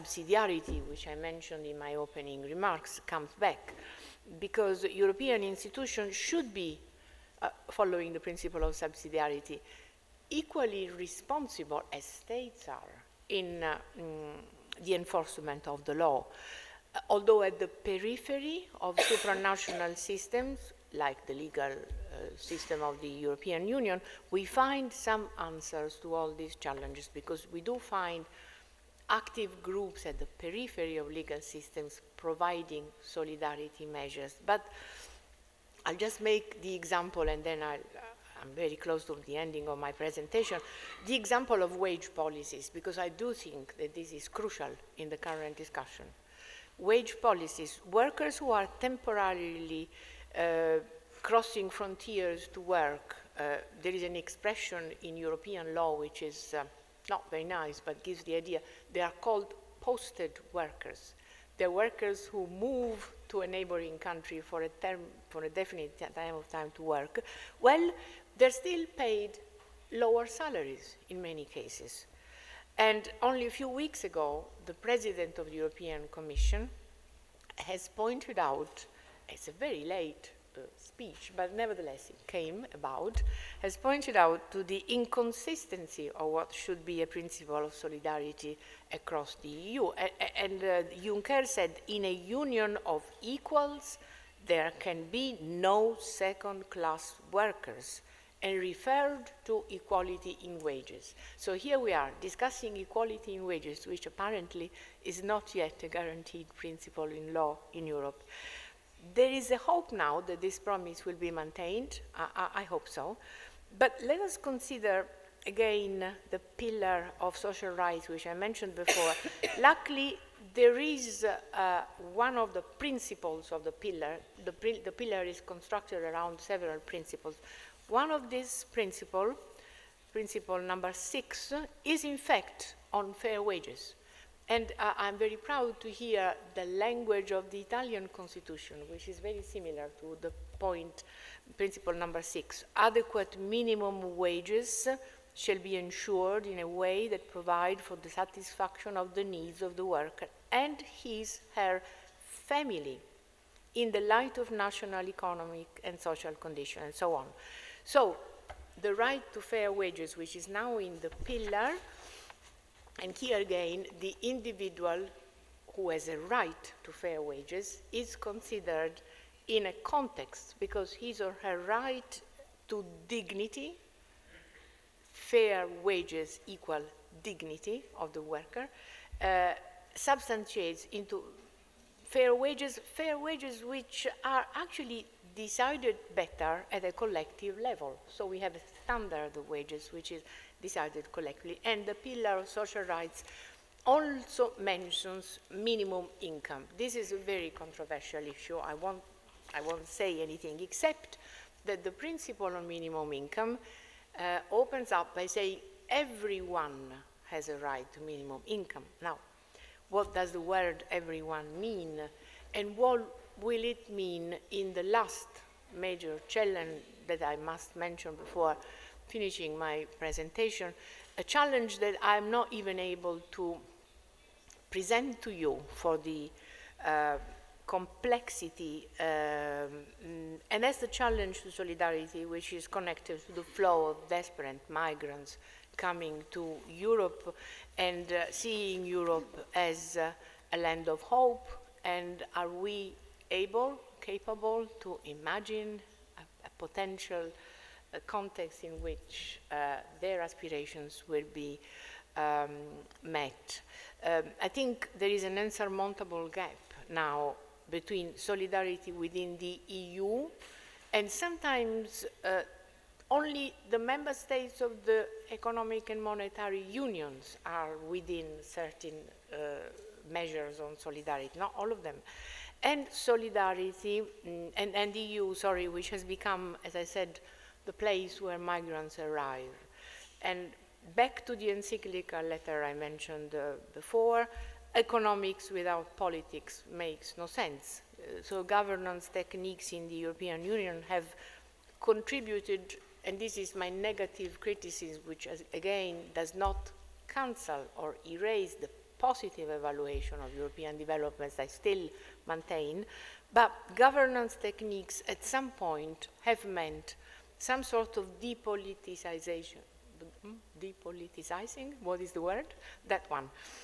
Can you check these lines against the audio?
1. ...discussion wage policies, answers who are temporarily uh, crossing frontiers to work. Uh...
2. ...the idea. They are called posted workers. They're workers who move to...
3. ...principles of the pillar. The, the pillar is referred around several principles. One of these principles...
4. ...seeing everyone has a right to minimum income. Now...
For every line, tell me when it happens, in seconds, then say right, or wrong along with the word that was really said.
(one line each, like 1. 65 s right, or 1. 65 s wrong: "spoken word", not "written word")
1. 45 s wrong: "workers", not "answers"
2. 58 s right
3. 122 s wrong: "constructed", not "referred"
4. 205 s wrong: "saying", not "seeing".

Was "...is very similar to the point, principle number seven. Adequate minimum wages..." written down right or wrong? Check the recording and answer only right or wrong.
wrong.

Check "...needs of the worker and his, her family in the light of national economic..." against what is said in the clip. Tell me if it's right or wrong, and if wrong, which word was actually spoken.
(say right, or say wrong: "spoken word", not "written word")
right.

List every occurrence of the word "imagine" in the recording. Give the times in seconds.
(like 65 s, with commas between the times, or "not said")
245 s.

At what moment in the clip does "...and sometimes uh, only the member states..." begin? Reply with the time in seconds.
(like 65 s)
260 s.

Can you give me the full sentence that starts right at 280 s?
And back to the encyclical letter I mentioned uh, before, economics without politics makes no sense.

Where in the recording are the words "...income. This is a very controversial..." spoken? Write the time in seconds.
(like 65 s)
196 s.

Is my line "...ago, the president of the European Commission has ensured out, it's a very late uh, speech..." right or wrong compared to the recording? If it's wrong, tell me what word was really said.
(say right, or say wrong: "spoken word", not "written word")
wrong: "pointed", not "ensured".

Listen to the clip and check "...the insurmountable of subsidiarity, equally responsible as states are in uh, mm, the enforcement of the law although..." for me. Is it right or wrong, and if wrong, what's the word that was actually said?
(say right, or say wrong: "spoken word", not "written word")
wrong: "principle", not "insurmountable".